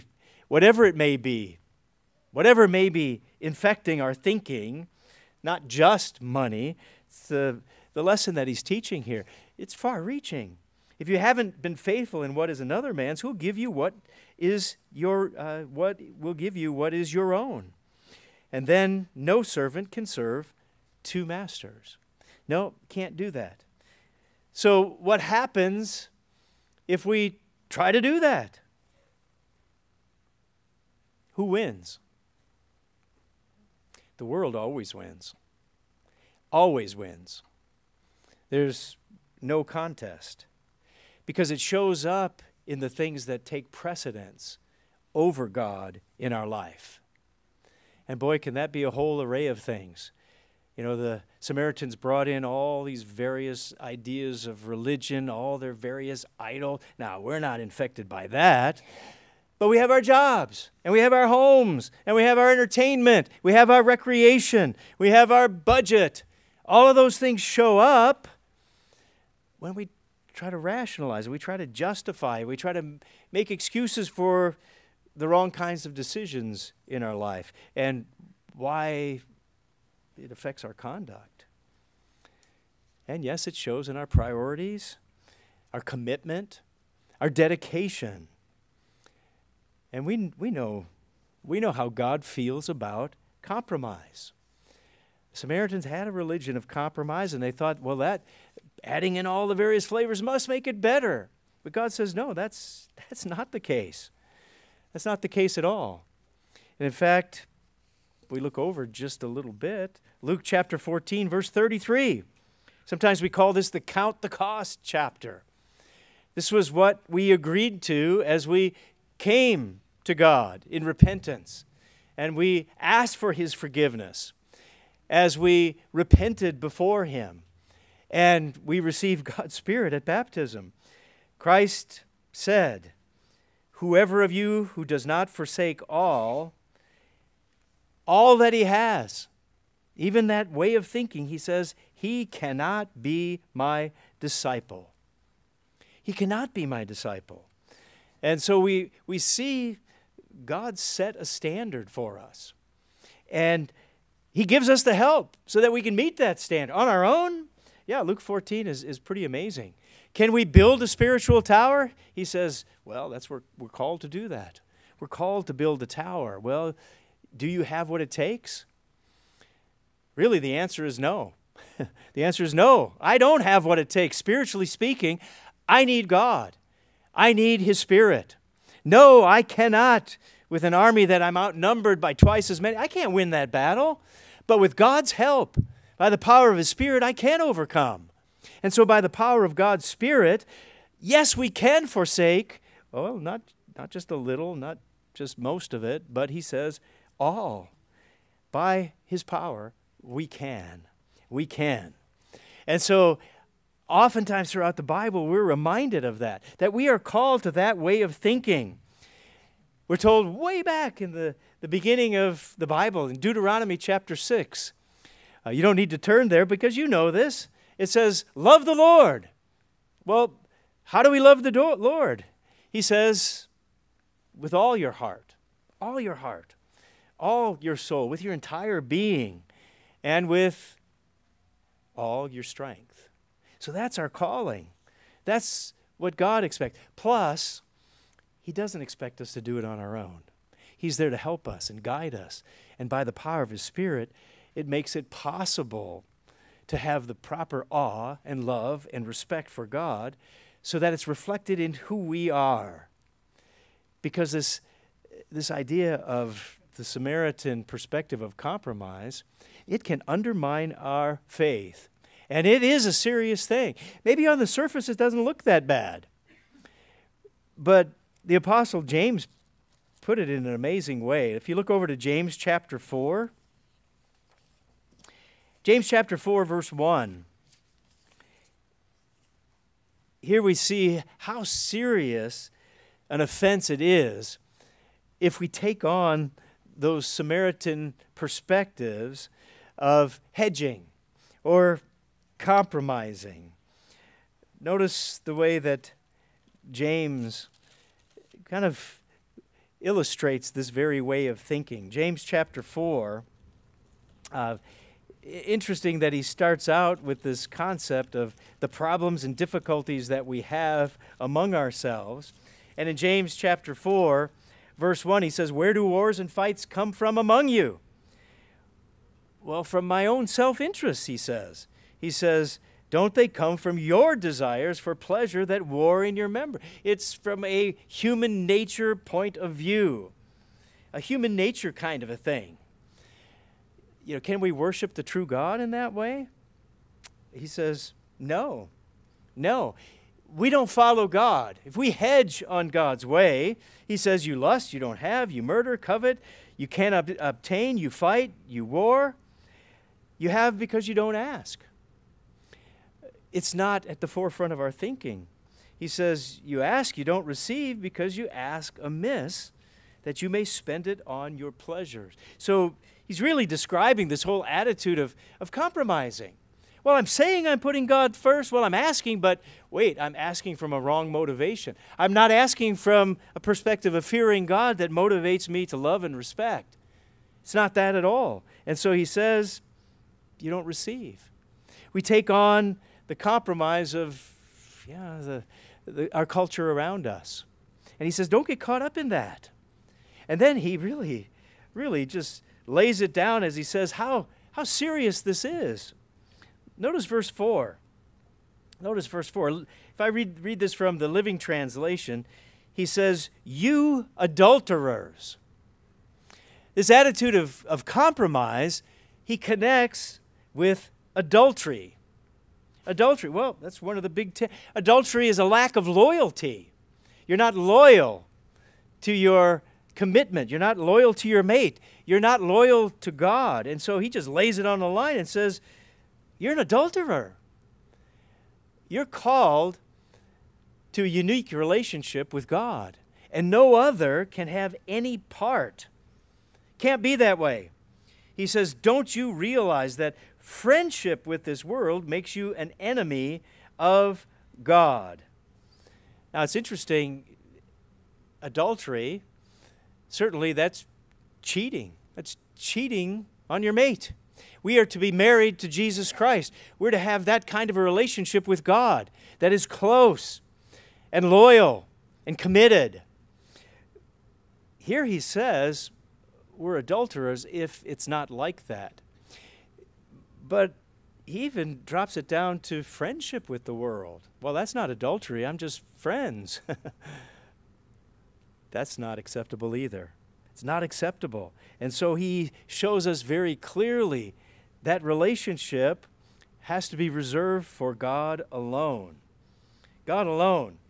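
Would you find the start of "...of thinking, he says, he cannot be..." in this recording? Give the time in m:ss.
2:20.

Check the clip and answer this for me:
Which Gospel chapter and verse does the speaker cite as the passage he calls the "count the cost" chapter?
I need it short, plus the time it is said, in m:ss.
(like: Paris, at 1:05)
Luke 14:33, at 1:50.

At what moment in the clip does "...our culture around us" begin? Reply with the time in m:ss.
6:26.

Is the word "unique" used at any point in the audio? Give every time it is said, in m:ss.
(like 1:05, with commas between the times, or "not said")
7:11.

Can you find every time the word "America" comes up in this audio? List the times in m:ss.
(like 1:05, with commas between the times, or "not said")
not said.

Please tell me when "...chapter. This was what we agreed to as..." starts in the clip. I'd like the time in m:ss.
1:54.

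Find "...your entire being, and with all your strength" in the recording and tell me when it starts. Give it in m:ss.
3:48.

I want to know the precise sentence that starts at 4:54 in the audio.
Notice the way that James kind of illustrates this very way of thinking.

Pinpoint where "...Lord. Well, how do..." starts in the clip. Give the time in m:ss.
3:38.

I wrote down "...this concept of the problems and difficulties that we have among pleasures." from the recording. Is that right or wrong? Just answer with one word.
wrong.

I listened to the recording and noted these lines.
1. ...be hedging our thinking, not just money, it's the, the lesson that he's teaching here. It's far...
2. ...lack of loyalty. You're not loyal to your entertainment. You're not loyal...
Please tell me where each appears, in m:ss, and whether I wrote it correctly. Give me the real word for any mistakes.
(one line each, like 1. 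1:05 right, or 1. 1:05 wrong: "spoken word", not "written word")
1. 0:02 wrong: "infecting", not "hedging"
2. 6:55 wrong: "commitment", not "entertainment".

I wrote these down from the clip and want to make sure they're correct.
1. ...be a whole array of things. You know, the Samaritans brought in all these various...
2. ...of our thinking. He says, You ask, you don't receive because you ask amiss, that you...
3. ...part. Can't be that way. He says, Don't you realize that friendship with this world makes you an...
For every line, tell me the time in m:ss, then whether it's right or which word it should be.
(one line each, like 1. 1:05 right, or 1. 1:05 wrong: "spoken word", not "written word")
1. 0:48 right
2. 5:54 right
3. 7:15 right.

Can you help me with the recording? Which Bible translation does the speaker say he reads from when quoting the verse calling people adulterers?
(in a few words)
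Living Translation.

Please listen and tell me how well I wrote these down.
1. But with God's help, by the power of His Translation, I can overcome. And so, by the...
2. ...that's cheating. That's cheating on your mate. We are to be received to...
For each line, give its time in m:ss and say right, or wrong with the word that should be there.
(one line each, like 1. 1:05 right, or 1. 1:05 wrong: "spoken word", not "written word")
1. 3:04 wrong: "Spirit", not "Translation"
2. 7:30 wrong: "married", not "received".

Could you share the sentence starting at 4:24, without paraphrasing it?
Maybe on the surface it doesn't look that bad.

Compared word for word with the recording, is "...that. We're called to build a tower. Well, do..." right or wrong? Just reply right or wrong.
right.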